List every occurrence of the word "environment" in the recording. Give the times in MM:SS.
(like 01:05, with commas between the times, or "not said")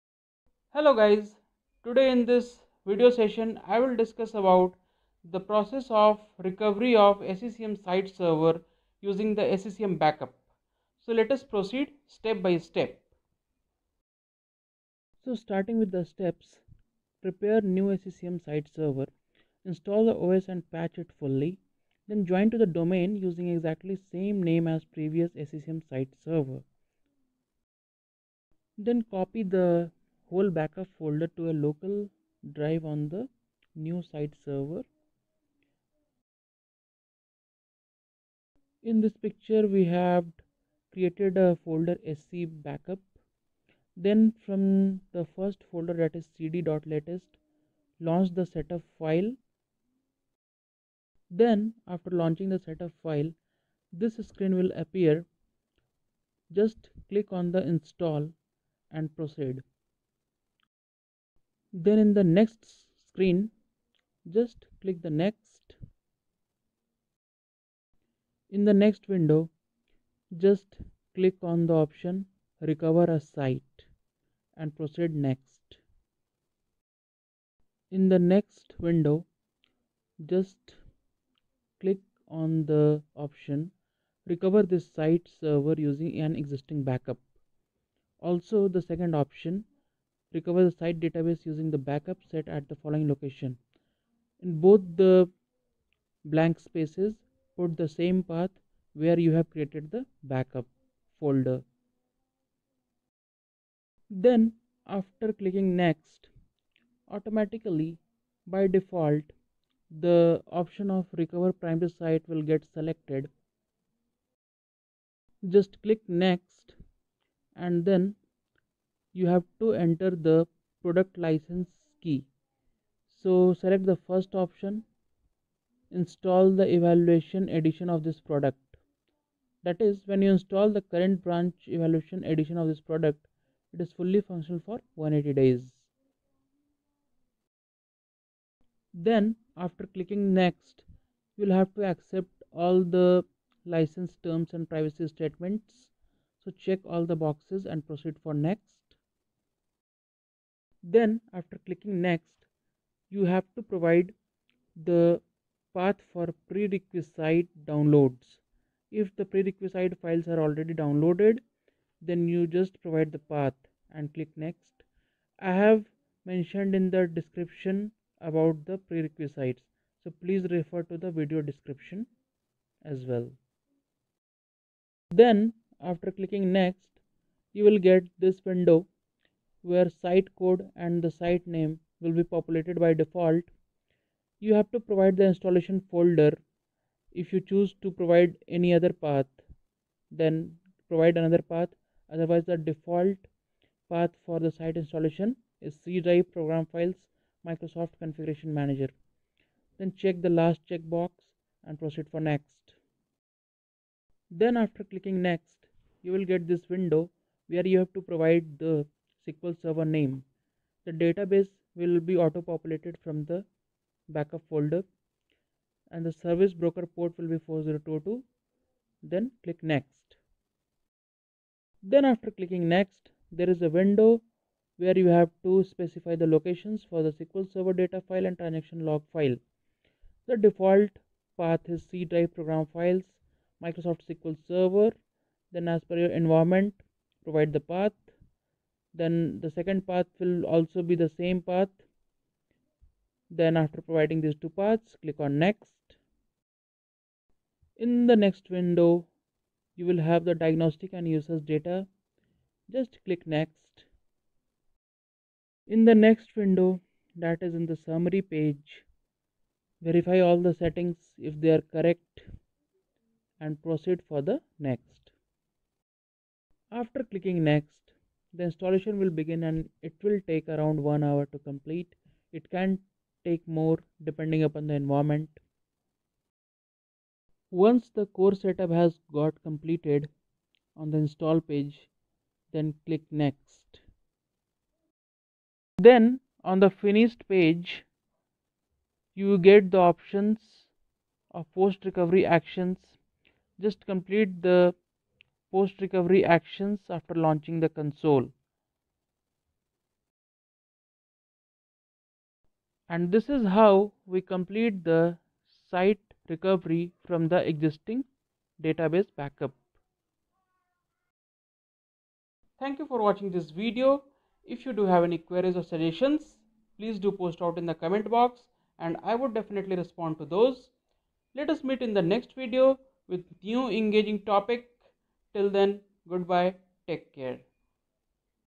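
03:56, 04:34.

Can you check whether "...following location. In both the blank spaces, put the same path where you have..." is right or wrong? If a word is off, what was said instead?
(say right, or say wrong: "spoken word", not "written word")
right.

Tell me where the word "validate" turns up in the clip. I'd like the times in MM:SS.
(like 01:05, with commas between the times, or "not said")
not said.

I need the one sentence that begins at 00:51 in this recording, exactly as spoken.
Then after launching the setup file this screen will appear.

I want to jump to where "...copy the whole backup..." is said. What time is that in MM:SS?
00:29.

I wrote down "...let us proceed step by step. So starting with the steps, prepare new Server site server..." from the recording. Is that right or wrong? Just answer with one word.
wrong.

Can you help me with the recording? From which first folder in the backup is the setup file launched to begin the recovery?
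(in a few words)
cd.latest.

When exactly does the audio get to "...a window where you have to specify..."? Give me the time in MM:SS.
03:43.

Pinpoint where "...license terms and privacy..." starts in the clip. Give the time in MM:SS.
02:23.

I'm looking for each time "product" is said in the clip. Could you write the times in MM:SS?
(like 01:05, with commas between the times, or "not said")
02:00, 02:08, 02:12.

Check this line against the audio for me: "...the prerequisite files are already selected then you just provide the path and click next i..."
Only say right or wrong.
wrong.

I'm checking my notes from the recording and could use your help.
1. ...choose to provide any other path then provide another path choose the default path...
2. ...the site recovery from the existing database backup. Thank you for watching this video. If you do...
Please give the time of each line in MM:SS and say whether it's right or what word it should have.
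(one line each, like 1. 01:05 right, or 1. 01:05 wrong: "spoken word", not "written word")
1. 03:07 wrong: "otherwise", not "choose"
2. 05:04 right.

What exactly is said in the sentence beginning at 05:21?
Let us meet in the next video with new engaging topic Till then, goodbye, take care.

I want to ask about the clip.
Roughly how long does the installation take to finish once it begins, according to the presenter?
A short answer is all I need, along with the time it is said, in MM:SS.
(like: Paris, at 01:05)
one hour, at 04:30.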